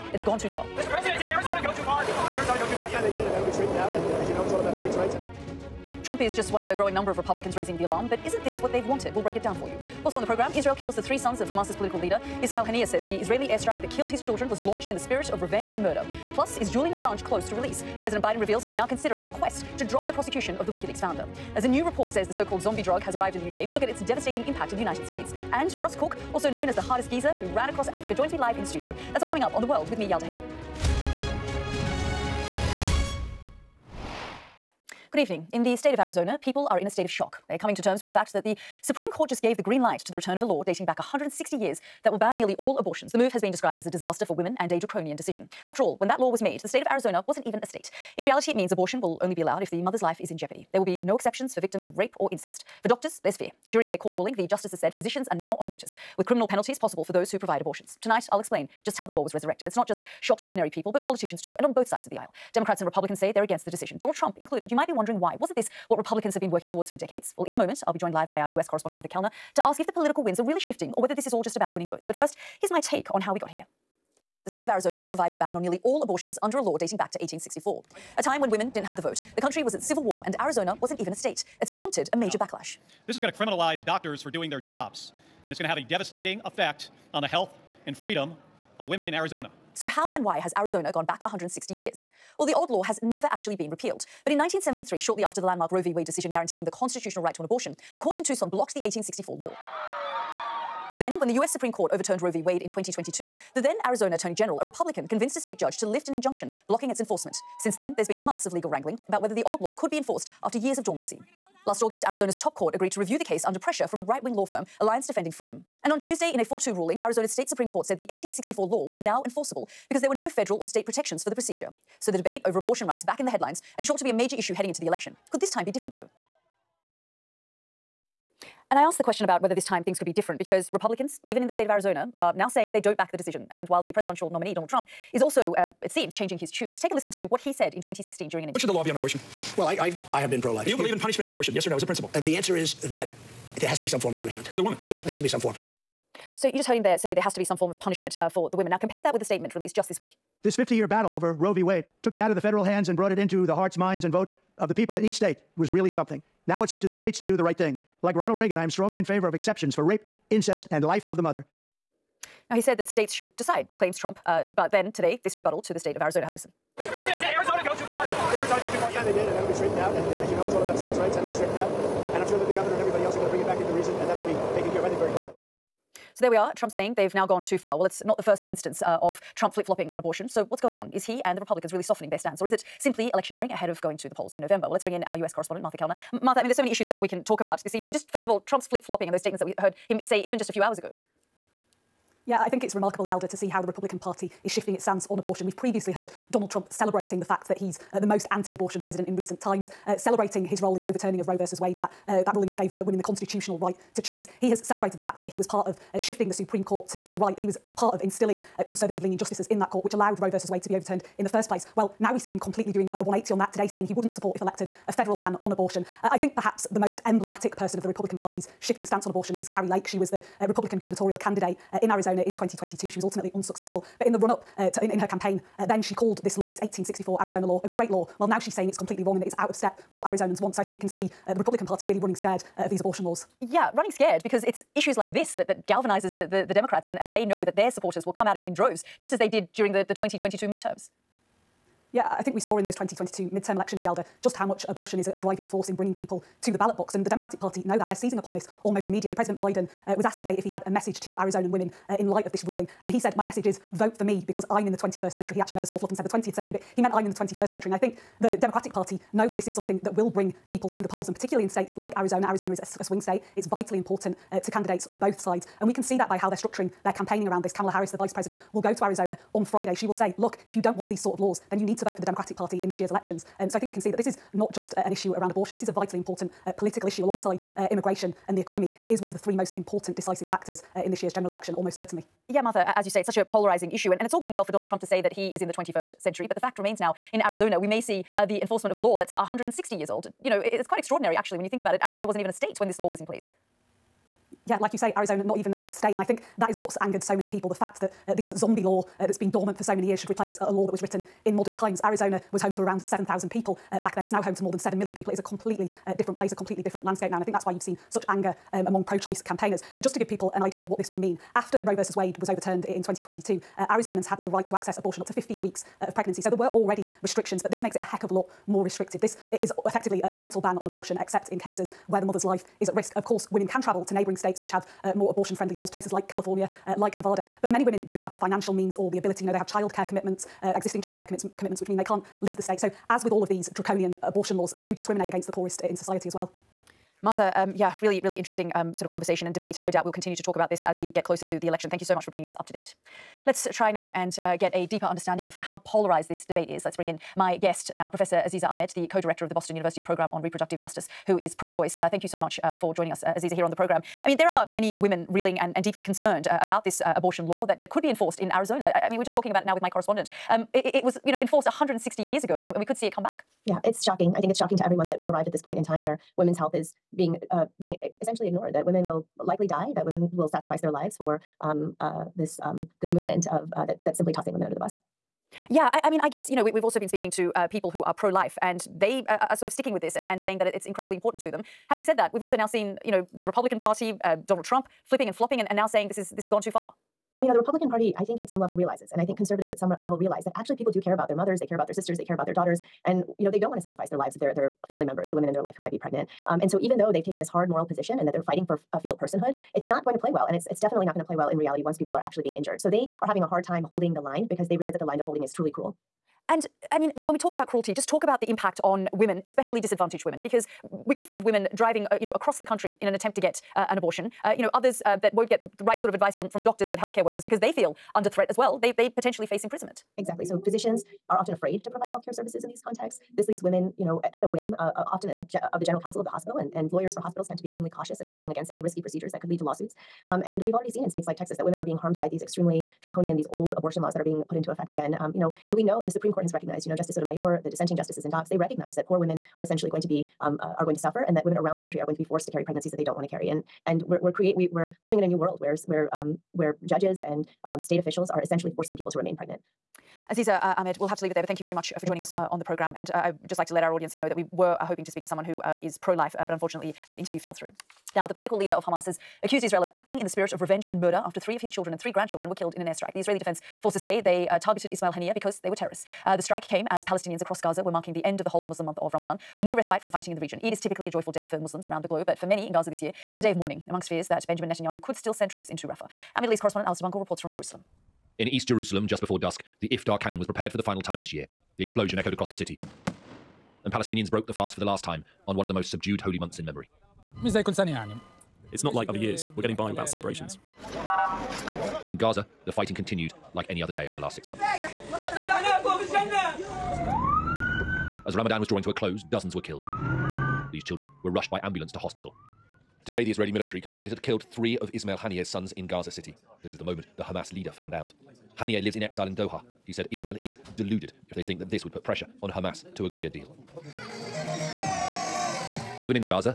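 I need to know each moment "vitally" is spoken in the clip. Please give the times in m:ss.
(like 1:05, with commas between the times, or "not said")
4:23, 4:35.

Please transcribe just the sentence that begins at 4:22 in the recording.
Arizona is a, a swing state.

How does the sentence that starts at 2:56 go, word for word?
So there we are, Trump saying they've now gone too far.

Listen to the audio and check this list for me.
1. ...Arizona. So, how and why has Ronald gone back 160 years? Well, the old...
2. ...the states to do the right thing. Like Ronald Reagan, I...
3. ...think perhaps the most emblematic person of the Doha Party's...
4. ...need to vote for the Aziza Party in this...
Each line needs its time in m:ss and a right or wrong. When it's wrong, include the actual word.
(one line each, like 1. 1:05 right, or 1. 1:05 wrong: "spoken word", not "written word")
1. 1:29 wrong: "Arizona", not "Ronald"
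2. 2:36 right
3. 3:36 wrong: "Republican", not "Doha"
4. 4:31 wrong: "Democratic", not "Aziza".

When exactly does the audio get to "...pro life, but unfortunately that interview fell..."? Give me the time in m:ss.
7:35.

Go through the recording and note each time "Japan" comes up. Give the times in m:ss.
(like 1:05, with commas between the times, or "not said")
not said.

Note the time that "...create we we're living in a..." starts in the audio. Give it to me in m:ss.
7:24.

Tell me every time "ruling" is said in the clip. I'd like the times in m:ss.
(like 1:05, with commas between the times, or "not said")
0:54, 1:56, 3:22, 4:12.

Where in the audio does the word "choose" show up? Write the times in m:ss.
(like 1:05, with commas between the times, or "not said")
3:23.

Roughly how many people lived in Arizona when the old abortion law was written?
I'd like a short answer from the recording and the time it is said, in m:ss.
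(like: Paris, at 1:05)
7,000, at 5:02.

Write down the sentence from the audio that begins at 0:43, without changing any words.
The move has been described as a disaster for women and a draconian decision.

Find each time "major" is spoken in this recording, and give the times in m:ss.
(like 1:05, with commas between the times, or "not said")
1:22, 2:04.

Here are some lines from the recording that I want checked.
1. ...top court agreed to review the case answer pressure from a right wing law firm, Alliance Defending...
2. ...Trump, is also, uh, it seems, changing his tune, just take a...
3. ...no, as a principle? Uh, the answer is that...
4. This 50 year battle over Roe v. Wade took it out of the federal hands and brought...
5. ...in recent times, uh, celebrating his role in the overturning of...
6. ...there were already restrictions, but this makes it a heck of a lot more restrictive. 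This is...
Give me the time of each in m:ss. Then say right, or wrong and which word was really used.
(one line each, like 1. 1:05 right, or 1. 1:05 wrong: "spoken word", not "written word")
1. 1:52 wrong: "under", not "answer"
2. 2:14 right
3. 2:21 right
4. 2:30 right
5. 3:19 right
6. 5:16 right.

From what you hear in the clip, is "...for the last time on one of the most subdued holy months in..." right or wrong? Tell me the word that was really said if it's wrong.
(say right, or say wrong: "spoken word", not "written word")
right.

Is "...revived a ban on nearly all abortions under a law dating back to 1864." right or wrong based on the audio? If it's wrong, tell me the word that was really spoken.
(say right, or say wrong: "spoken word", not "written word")
right.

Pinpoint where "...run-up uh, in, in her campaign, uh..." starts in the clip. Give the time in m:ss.
3:44.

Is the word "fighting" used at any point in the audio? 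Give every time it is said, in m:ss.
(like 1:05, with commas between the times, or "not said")
6:38, 7:49, 8:12.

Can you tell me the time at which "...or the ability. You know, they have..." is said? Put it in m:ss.
5:28.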